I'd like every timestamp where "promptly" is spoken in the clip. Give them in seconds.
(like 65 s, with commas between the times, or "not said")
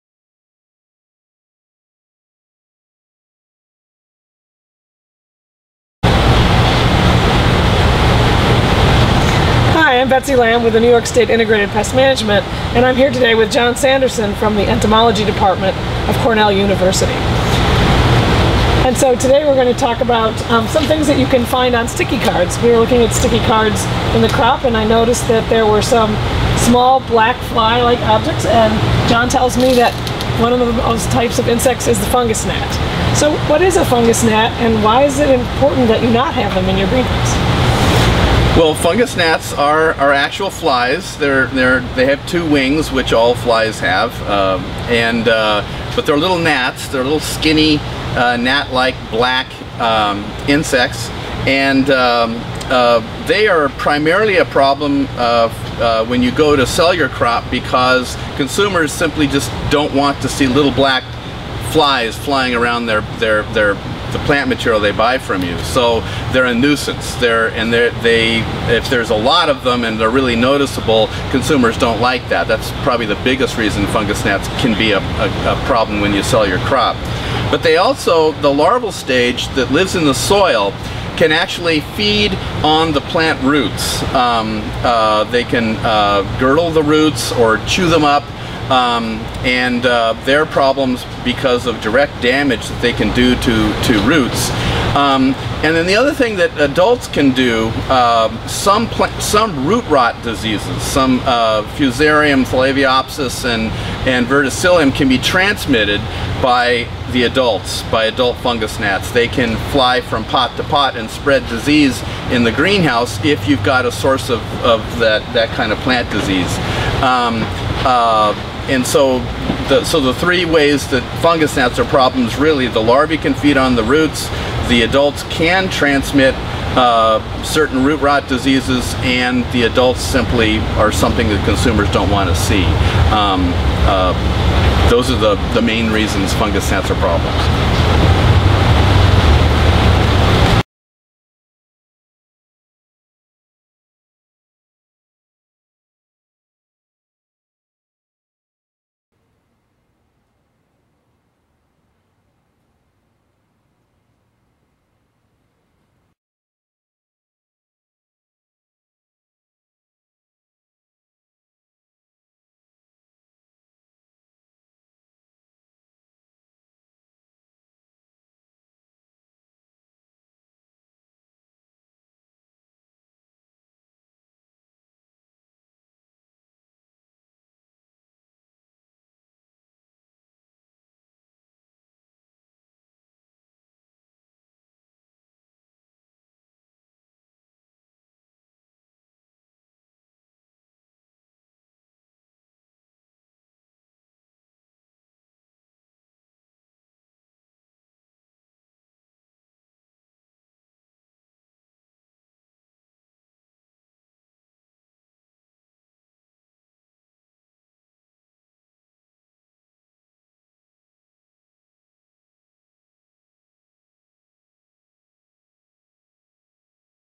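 not said.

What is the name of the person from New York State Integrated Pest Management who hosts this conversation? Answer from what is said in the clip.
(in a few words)
Betsy Lamb.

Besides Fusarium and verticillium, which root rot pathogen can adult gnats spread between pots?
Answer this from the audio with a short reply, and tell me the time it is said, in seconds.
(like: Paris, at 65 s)
Thielaviopsis, at 102 s.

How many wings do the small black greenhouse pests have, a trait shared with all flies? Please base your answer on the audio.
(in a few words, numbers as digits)
2.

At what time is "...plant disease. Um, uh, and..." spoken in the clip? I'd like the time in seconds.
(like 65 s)
115 s.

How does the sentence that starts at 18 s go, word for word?
And so today we're going to talk about um, some things that you can find on sticky cards.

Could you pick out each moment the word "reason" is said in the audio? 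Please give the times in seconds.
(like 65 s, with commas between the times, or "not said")
73 s, 135 s.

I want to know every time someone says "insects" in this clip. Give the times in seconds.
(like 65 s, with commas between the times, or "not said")
31 s, 50 s.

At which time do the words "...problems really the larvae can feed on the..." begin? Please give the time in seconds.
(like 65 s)
121 s.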